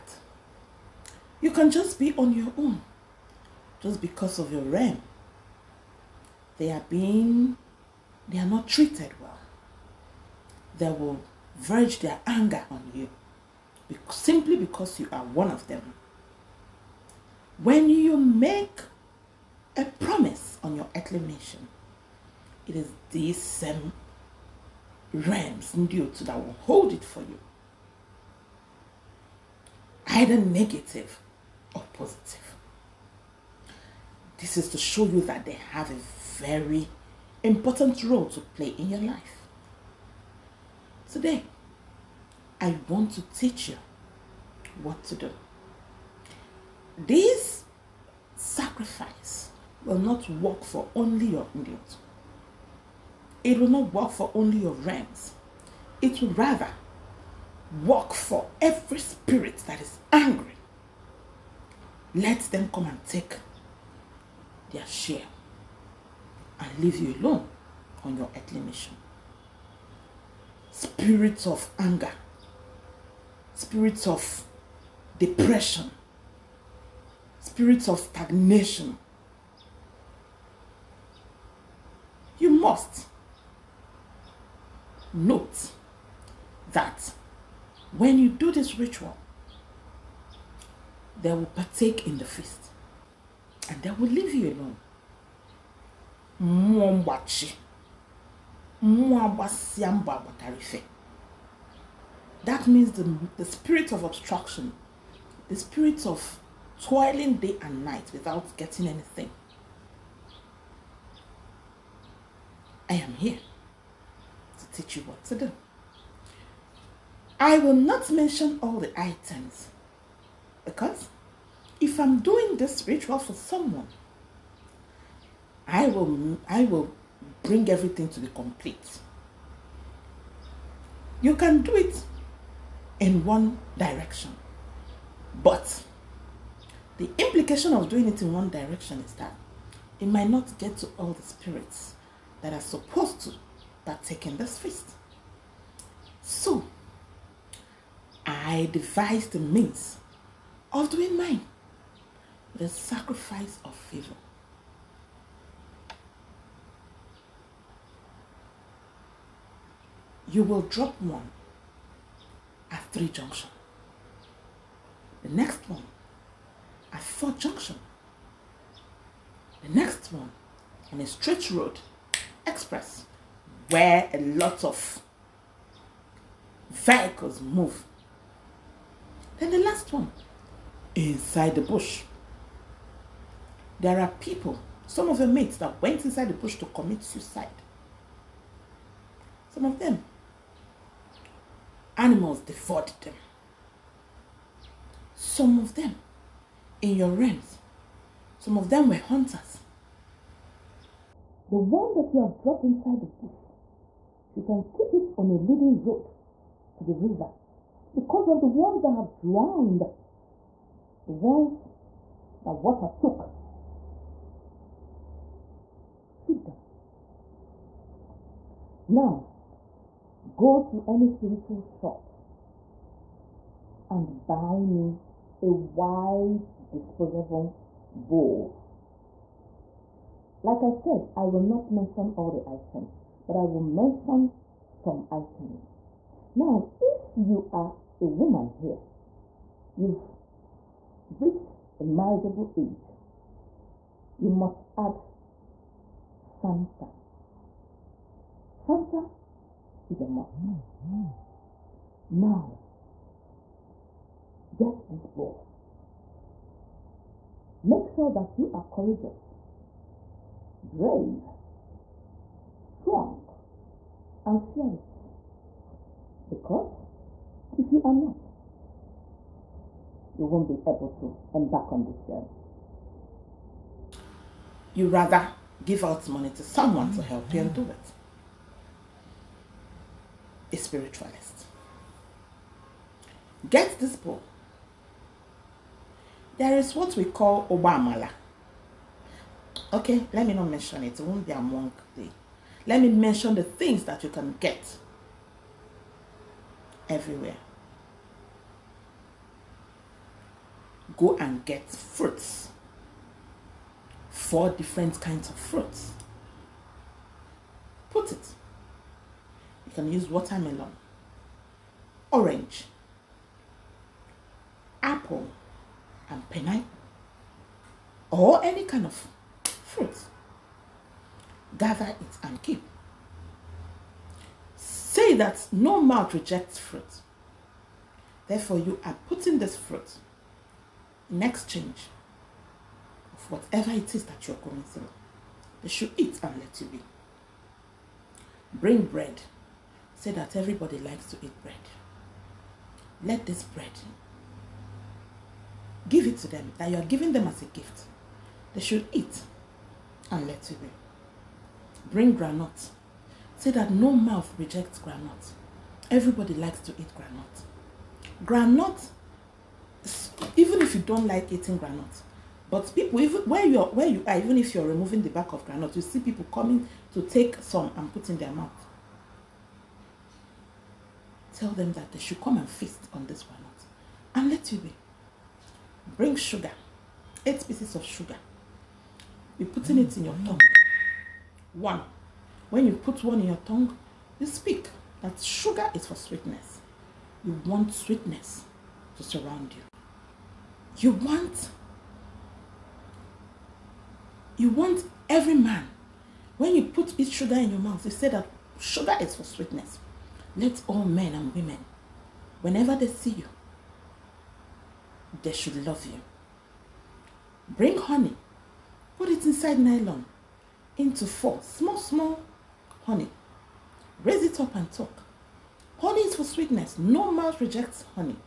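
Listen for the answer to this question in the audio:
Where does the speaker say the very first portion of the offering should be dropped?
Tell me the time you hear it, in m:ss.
2:42.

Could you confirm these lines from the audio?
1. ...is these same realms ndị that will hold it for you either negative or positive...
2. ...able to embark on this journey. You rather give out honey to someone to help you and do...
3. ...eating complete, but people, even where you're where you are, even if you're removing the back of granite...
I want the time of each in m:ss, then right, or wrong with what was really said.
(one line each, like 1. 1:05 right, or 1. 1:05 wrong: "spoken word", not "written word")
1. 0:22 right
2. 4:30 wrong: "money", not "honey"
3. 6:01 wrong: "granite", not "complete".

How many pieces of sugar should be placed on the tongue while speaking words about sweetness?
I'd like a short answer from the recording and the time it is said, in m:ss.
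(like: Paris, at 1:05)
8, at 6:17.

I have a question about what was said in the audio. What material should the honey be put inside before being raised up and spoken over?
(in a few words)
nylon.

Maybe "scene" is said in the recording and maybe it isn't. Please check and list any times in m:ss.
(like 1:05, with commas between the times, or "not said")
not said.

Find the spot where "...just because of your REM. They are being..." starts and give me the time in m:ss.
0:03.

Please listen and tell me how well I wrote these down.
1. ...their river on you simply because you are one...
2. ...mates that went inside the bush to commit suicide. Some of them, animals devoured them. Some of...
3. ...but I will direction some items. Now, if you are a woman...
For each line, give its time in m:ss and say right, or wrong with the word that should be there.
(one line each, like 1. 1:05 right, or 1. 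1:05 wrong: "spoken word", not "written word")
1. 0:11 wrong: "anger", not "river"
2. 3:05 right
3. 3:53 wrong: "mention", not "direction".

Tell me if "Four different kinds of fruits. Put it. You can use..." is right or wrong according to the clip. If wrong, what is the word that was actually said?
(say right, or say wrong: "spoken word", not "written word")
right.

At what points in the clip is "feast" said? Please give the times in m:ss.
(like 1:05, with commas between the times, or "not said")
1:32, 2:24, 6:12.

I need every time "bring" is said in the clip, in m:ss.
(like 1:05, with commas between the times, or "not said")
2:07, 5:38, 5:51, 6:15, 6:47.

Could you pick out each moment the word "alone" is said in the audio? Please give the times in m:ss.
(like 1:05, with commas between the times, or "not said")
1:07, 1:34.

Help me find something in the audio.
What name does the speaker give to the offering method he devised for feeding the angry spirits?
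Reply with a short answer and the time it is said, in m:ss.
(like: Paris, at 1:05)
sacrifice of favor, at 2:32.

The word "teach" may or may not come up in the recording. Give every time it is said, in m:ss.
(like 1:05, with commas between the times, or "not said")
0:43, 1:54.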